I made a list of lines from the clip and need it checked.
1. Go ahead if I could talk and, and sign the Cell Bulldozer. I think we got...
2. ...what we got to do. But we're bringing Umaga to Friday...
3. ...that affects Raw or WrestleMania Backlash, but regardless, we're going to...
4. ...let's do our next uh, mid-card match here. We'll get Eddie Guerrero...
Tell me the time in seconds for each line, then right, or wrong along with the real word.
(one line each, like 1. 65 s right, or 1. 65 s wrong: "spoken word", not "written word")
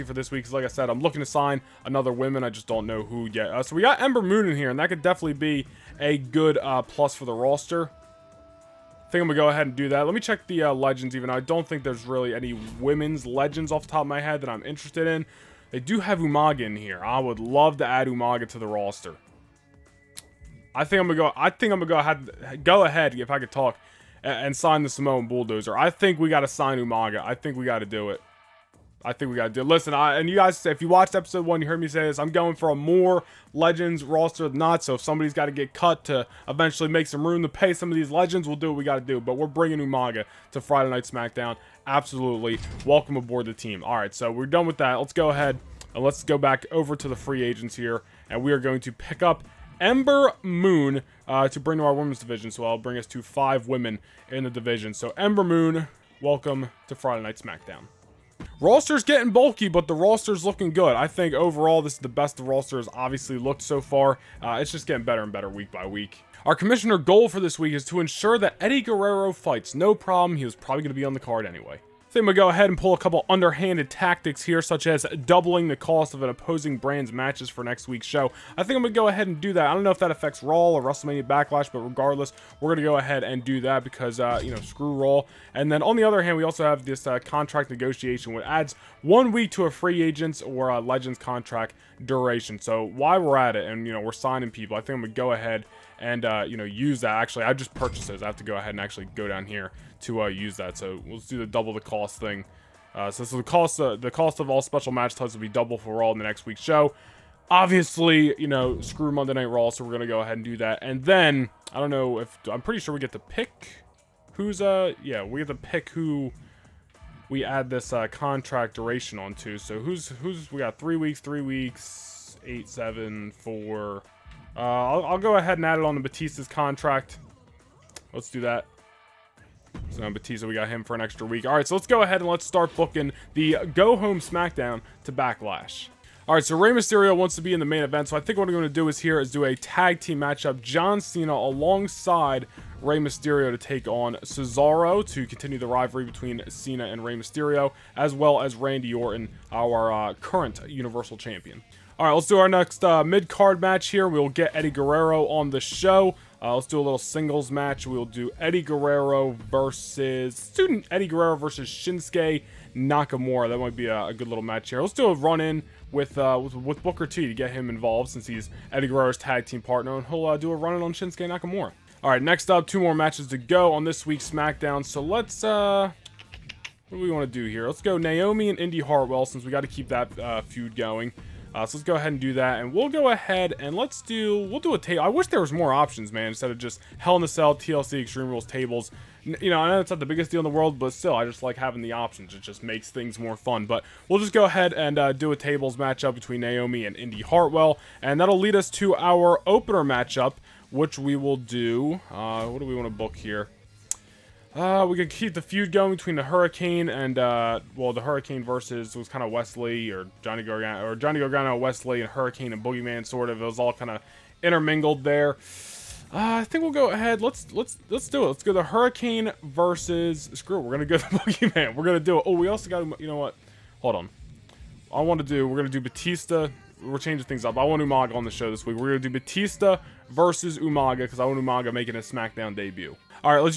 1. 22 s wrong: "Samoan", not "Cell"
2. 38 s right
3. 79 s right
4. 152 s right.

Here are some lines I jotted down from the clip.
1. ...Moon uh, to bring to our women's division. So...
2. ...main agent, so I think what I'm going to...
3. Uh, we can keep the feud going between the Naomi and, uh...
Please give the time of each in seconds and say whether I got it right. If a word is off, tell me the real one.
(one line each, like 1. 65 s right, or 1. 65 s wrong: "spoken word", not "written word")
1. 50 s right
2. 137 s wrong: "event", not "agent"
3. 204 s wrong: "Hurricane", not "Naomi".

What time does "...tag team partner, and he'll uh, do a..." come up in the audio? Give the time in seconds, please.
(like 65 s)
169 s.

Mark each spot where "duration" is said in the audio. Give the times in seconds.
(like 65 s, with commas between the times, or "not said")
92 s, 118 s.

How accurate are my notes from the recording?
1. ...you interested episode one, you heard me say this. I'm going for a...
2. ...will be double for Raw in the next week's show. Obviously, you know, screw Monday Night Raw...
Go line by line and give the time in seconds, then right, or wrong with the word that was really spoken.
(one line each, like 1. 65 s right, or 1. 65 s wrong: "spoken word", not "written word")
1. 30 s wrong: "watched", not "interested"
2. 105 s right.